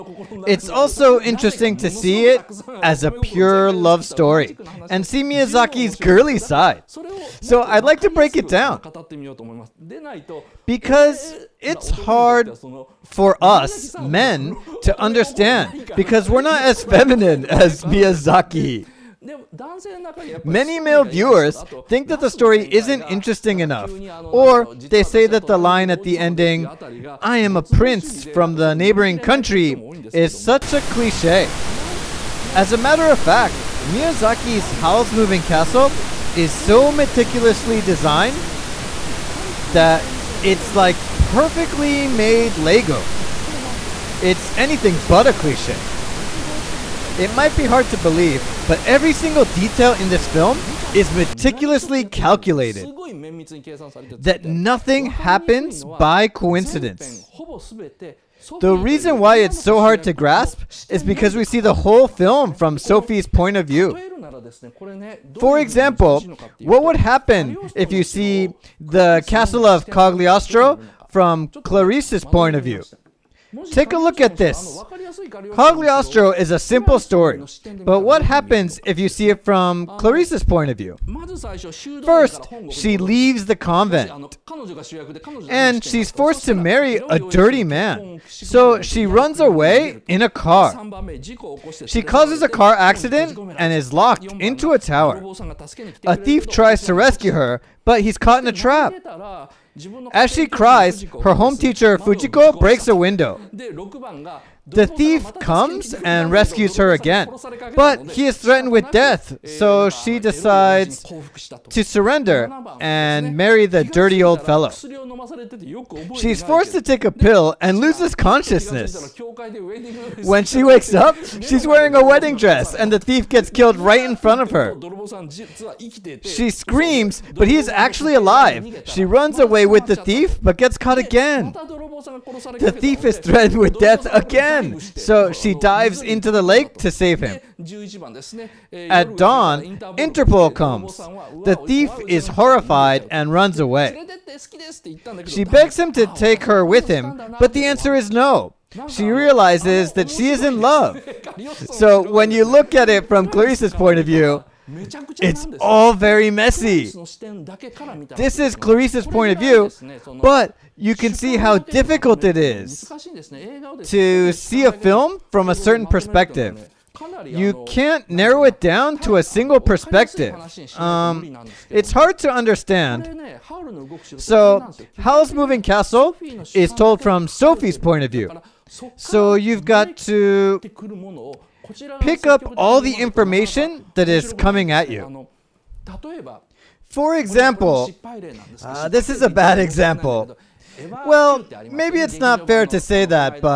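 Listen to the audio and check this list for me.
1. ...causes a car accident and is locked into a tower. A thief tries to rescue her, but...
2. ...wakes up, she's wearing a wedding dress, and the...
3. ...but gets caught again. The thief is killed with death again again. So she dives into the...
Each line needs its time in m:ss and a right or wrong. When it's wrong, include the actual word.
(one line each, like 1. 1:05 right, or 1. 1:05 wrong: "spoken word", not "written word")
1. 1:32 right
2. 2:00 right
3. 2:10 wrong: "threatened", not "killed".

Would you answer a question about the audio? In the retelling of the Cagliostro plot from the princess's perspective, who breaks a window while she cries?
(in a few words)
Fujiko.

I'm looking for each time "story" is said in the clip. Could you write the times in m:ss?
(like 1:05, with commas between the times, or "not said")
0:04, 0:22, 1:16.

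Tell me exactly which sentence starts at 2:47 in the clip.
You can't narrow it down to a single perspective.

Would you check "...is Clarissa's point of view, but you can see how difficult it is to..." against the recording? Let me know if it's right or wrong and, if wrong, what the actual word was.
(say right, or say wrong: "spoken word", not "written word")
right.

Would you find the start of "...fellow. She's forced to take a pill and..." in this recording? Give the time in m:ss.
1:54.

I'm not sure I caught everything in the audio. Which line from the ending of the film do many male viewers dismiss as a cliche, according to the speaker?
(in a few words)
I am a prince from the neighboring country.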